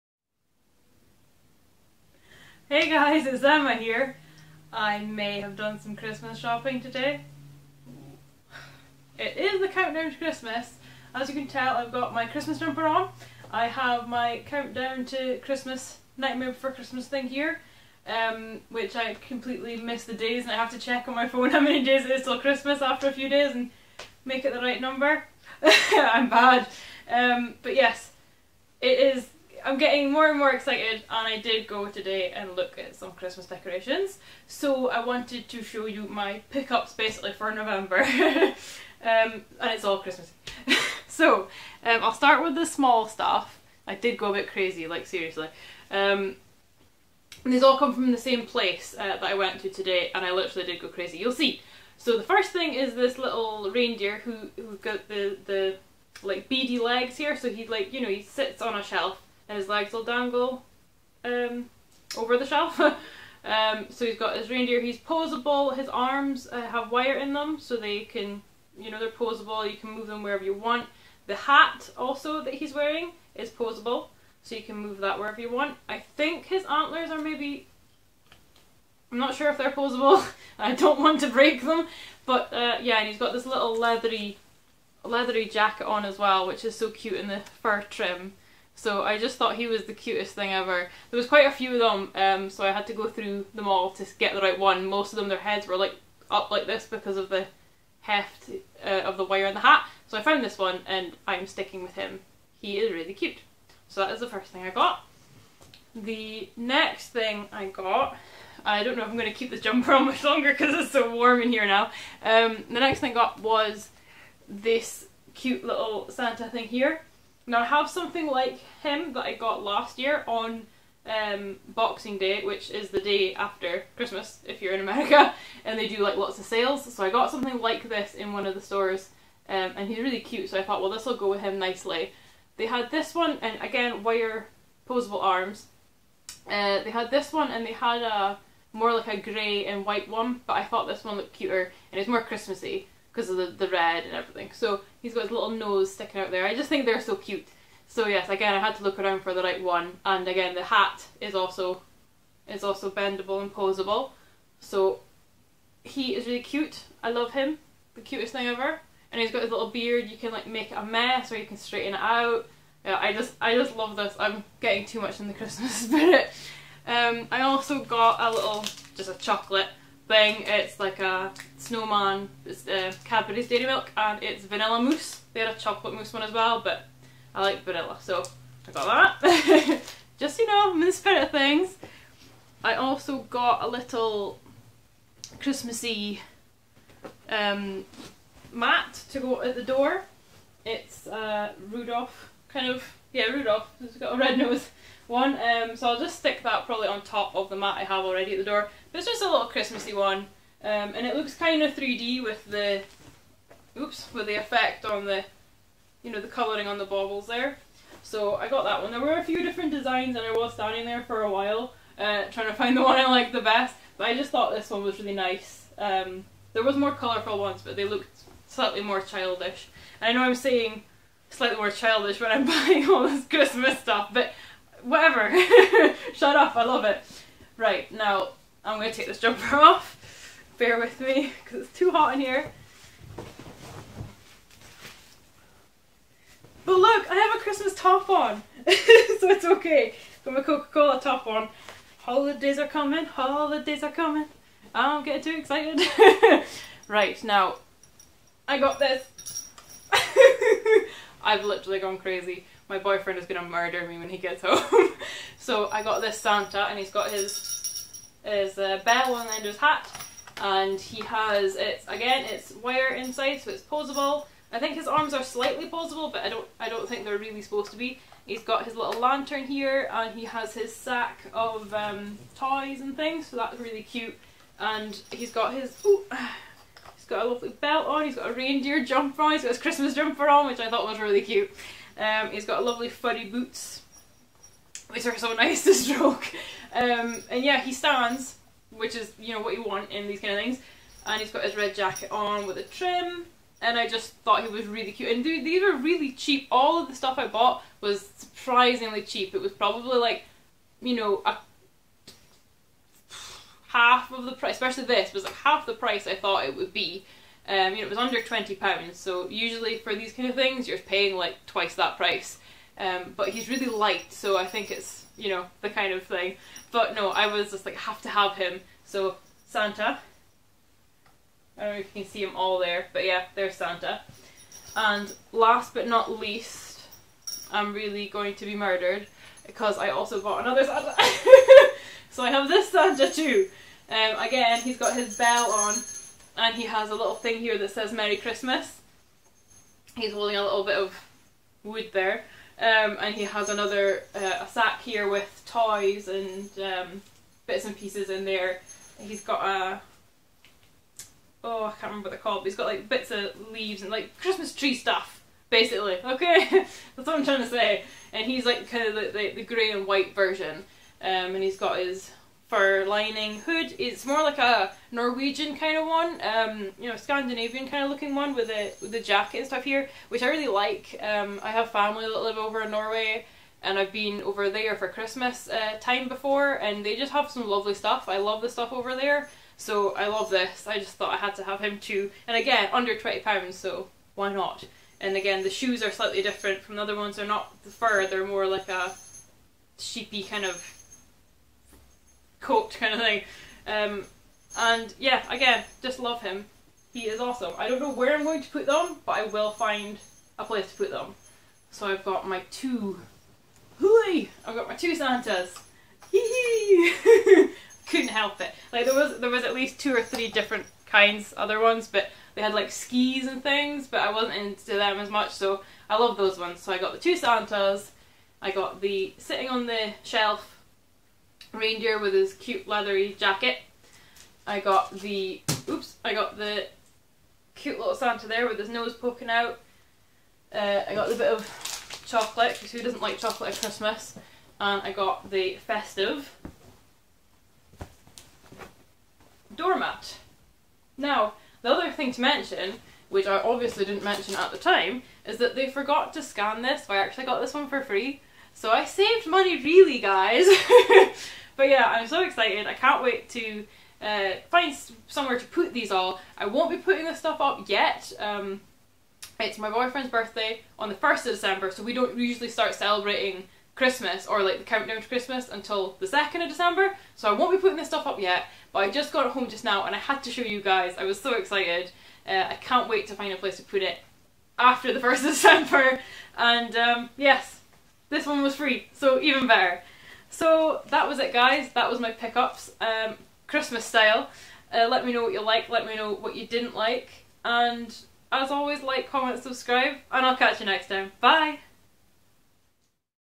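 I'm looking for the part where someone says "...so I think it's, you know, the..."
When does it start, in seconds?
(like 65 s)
314 s.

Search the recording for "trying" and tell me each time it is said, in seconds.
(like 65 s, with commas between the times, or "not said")
212 s, 357 s.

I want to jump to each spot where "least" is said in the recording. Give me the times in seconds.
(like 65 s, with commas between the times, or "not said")
326 s, 409 s.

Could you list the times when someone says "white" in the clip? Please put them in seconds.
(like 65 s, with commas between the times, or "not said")
139 s, 359 s.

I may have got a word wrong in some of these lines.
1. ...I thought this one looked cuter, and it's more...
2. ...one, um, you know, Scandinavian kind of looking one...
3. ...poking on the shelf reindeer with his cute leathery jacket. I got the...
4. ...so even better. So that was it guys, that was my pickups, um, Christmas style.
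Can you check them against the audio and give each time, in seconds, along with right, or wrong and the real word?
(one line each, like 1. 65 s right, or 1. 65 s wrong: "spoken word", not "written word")
1. 140 s right
2. 365 s right
3. 419 s wrong: "sitting", not "poking"
4. 478 s right.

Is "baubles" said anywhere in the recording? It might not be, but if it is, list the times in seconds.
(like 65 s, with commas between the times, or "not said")
206 s.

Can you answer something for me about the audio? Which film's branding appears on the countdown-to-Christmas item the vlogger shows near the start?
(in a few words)
Nightmare Before Christmas.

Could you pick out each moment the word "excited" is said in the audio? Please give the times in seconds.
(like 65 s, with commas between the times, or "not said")
30 s, 245 s, 452 s, 471 s.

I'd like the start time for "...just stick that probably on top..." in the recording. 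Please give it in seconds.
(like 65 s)
195 s.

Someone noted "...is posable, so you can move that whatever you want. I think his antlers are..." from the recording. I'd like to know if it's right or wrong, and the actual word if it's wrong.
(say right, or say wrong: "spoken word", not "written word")
wrong: "wherever", not "whatever".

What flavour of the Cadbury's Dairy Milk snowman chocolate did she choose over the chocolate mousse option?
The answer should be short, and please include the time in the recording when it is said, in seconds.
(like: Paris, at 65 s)
Vanilla mousse, at 174 s.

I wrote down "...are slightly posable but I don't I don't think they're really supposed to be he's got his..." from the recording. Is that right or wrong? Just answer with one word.
right.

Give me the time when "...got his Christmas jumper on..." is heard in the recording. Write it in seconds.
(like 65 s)
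279 s.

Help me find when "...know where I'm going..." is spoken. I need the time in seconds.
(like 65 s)
397 s.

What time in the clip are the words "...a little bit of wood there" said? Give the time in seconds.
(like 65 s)
340 s.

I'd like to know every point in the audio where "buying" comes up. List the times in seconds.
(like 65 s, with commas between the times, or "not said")
222 s.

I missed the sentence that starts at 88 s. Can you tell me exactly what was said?
So I just thought he was the cutest thing ever.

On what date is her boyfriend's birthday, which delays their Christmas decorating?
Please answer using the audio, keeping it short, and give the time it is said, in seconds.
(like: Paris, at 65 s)
1st of December, at 460 s.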